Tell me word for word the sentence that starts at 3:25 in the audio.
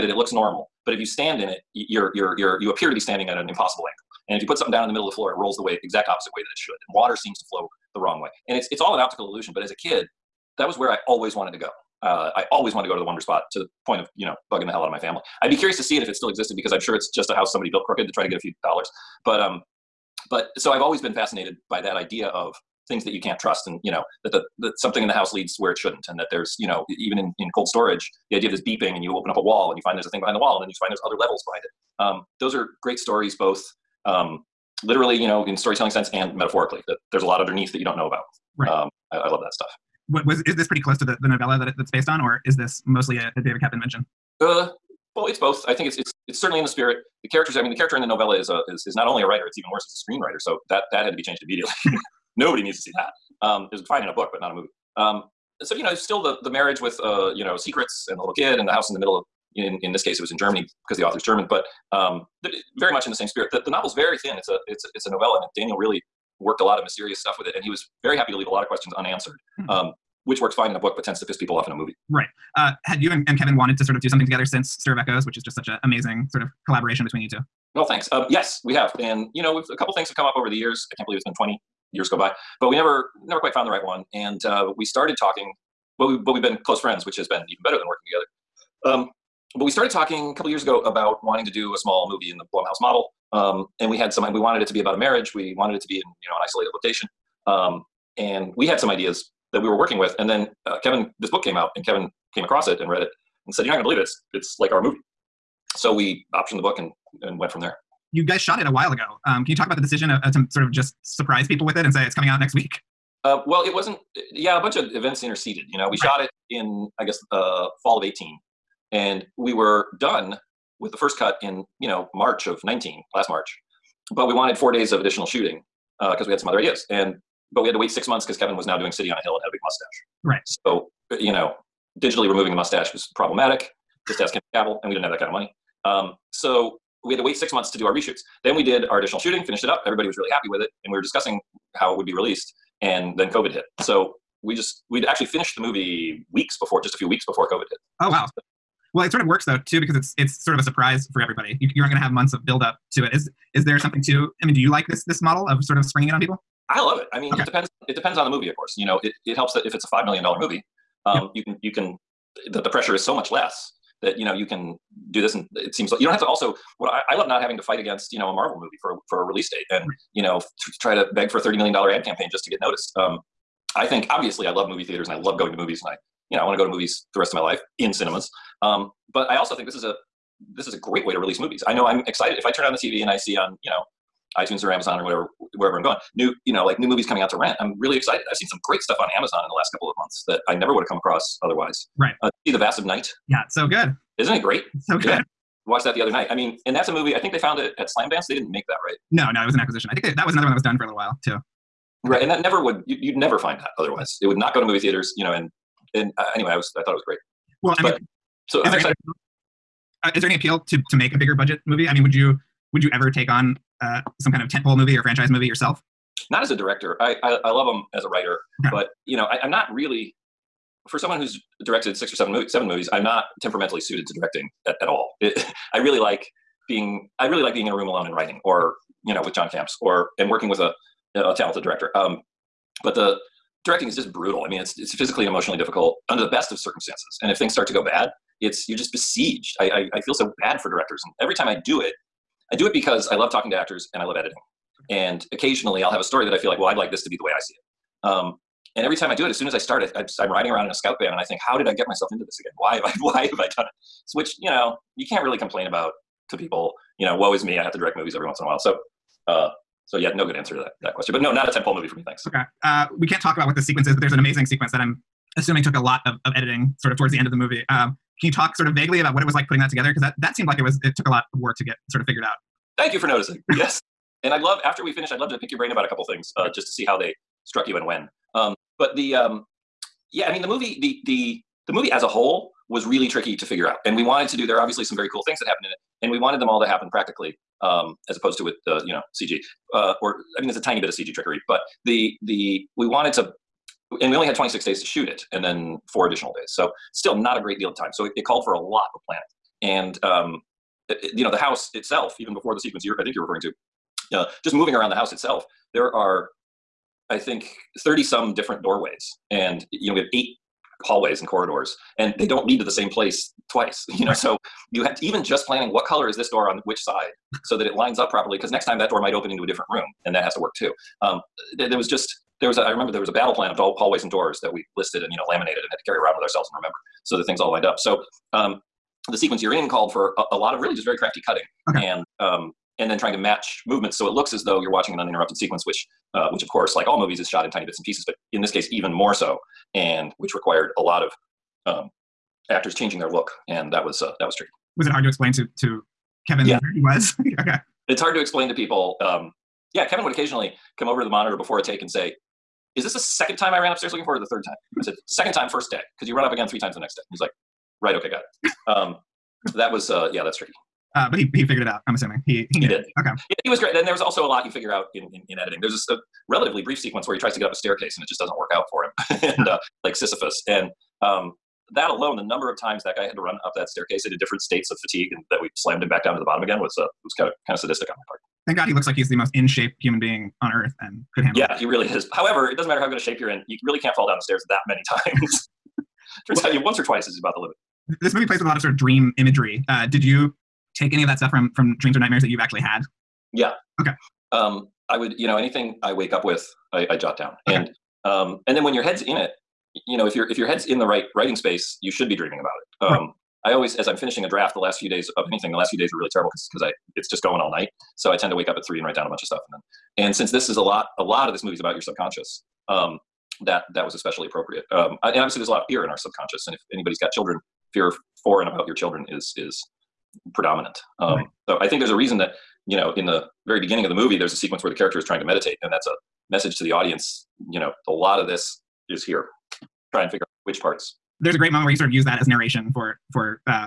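And and uh, anyway, I was I thought it was great.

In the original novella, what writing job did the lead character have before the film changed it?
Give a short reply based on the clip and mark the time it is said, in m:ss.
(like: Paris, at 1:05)
screenwriter, at 0:49.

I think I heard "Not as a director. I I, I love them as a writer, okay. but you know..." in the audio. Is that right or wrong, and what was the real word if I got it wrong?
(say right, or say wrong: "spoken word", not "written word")
right.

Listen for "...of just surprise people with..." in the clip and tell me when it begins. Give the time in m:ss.
1:50.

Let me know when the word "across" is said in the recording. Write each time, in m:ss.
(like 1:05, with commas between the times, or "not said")
1:42, 3:10.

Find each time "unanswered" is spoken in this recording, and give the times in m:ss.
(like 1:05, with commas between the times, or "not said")
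1:08.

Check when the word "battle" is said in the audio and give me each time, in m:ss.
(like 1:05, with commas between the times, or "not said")
5:23.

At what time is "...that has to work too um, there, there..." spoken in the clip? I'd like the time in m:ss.
5:20.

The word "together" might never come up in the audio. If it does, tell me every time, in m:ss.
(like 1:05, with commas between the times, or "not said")
1:14, 1:28, 4:29.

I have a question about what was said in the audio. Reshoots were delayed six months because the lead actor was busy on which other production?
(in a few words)
City on a Hill.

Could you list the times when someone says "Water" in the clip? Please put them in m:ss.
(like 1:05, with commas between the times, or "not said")
0:06.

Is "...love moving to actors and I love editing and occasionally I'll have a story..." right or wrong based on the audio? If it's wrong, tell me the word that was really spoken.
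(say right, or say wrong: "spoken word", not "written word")
wrong: "talking", not "moving".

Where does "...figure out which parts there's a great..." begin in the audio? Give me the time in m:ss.
7:10.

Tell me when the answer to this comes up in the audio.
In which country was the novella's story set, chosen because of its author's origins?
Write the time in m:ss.
1:00.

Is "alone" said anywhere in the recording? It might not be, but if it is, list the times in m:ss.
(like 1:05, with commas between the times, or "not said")
3:47, 6:11.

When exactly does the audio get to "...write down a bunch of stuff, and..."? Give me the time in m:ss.
6:48.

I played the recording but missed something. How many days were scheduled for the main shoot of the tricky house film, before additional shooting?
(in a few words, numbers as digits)
26.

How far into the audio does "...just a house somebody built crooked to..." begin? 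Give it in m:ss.
0:17.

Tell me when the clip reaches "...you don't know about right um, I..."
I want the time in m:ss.
0:37.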